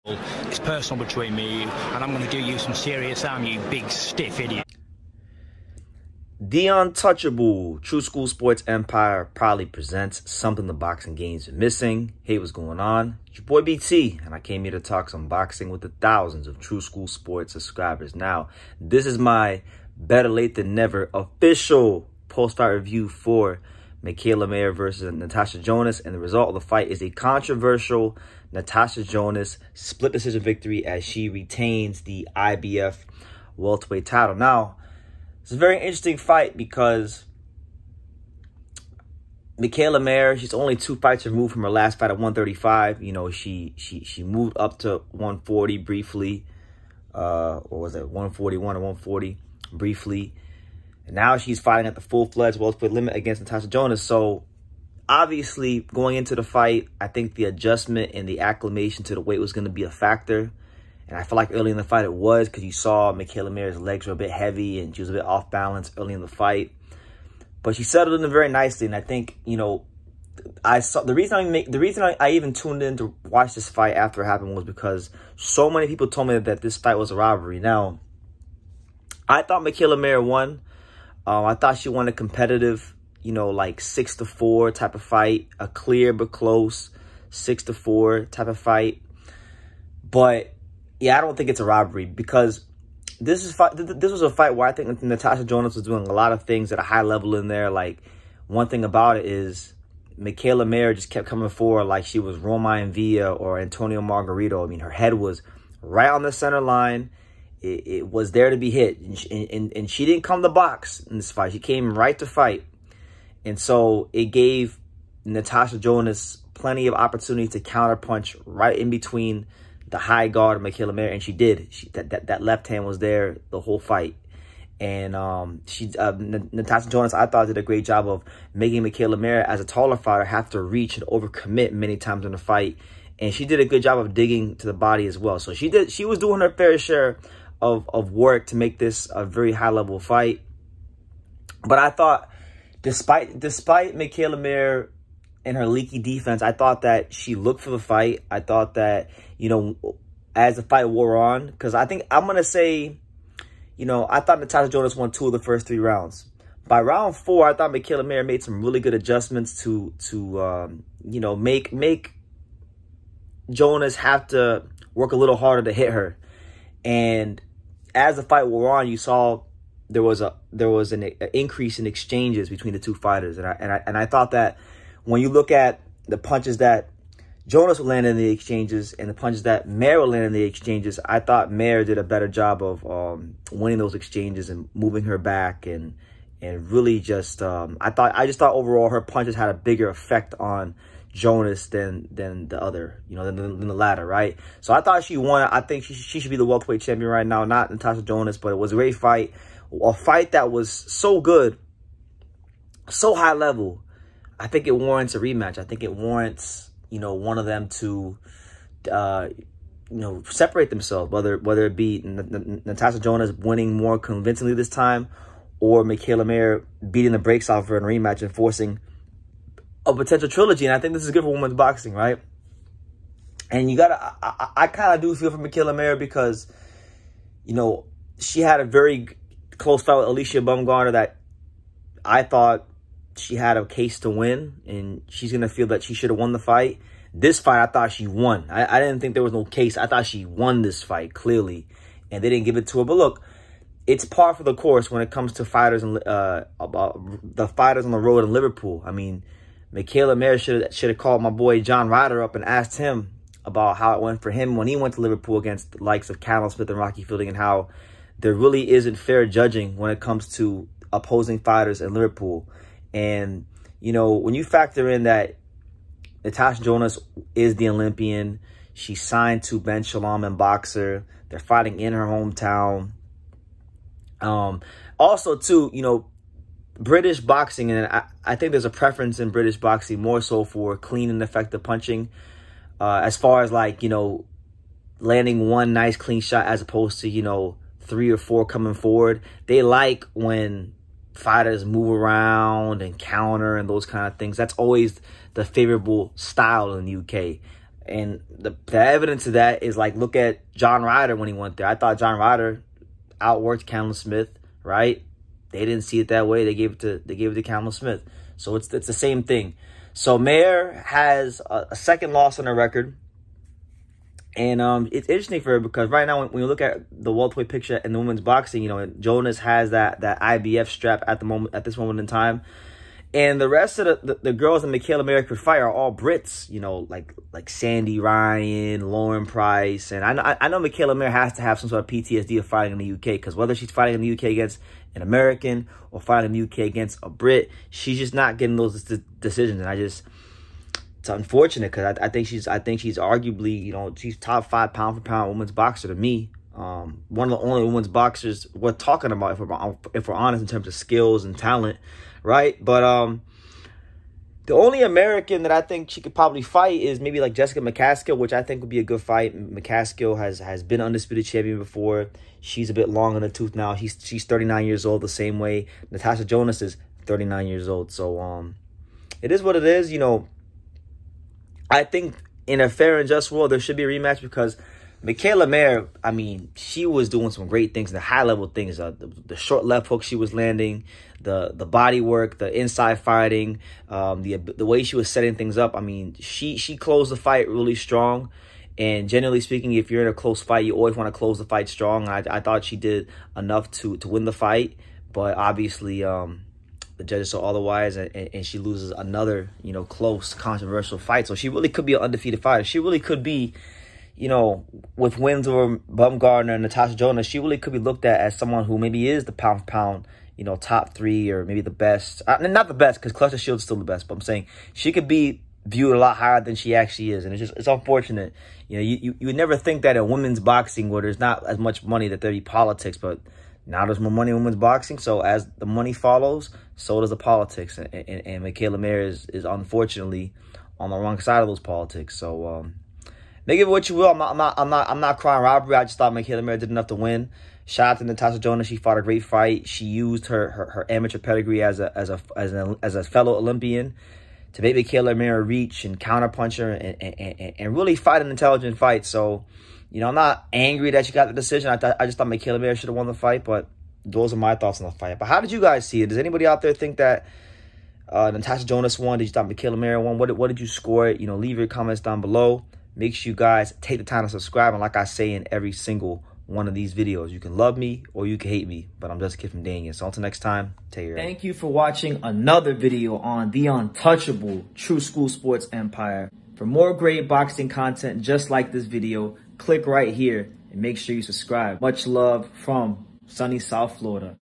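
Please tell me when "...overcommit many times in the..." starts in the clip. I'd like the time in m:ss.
2:11.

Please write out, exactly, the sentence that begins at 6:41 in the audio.
So she really could be an undefeated fighter.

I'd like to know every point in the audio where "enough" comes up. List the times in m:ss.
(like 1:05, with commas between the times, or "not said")
6:33, 7:16.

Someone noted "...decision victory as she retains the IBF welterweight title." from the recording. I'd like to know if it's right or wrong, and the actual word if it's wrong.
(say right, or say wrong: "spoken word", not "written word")
right.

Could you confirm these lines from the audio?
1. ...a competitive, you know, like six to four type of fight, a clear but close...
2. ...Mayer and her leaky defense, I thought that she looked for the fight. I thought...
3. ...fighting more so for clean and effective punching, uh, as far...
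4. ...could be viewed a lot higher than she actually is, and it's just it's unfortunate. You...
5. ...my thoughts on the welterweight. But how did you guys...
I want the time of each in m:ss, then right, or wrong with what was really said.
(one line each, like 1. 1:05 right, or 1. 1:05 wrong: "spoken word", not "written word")
1. 1:22 right
2. 2:24 right
3. 4:39 wrong: "boxing", not "fighting"
4. 6:54 right
5. 7:34 wrong: "fight", not "welterweight".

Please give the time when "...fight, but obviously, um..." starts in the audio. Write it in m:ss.
6:34.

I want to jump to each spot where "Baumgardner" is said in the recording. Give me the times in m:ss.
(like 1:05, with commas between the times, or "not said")
3:50, 6:45.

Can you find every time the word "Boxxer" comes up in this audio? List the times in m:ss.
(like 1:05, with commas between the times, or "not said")
4:30.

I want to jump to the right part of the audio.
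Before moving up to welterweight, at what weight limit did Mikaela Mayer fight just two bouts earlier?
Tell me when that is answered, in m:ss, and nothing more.
0:42.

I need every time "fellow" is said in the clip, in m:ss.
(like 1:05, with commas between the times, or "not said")
7:23.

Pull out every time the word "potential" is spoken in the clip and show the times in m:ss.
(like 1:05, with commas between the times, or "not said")
3:39.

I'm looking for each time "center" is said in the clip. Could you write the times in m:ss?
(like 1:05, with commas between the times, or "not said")
1:46.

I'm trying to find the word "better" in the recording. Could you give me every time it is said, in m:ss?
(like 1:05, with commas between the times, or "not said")
0:19, 3:02.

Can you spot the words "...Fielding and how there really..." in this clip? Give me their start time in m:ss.
4:17.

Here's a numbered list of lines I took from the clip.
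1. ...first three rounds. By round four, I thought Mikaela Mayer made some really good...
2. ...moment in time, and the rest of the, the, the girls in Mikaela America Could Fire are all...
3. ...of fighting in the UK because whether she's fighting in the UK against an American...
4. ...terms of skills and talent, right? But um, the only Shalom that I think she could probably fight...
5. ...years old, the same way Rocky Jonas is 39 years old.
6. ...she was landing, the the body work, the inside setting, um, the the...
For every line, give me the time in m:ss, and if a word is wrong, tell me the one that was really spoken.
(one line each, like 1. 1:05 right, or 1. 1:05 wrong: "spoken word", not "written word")
1. 2:35 right
2. 5:21 right
3. 5:32 right
4. 5:50 wrong: "American", not "Shalom"
5. 6:04 wrong: "Natasha", not "Rocky"
6. 6:20 wrong: "fighting", not "setting".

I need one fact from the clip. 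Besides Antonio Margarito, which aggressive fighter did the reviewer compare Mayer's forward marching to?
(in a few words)
Roma Villa.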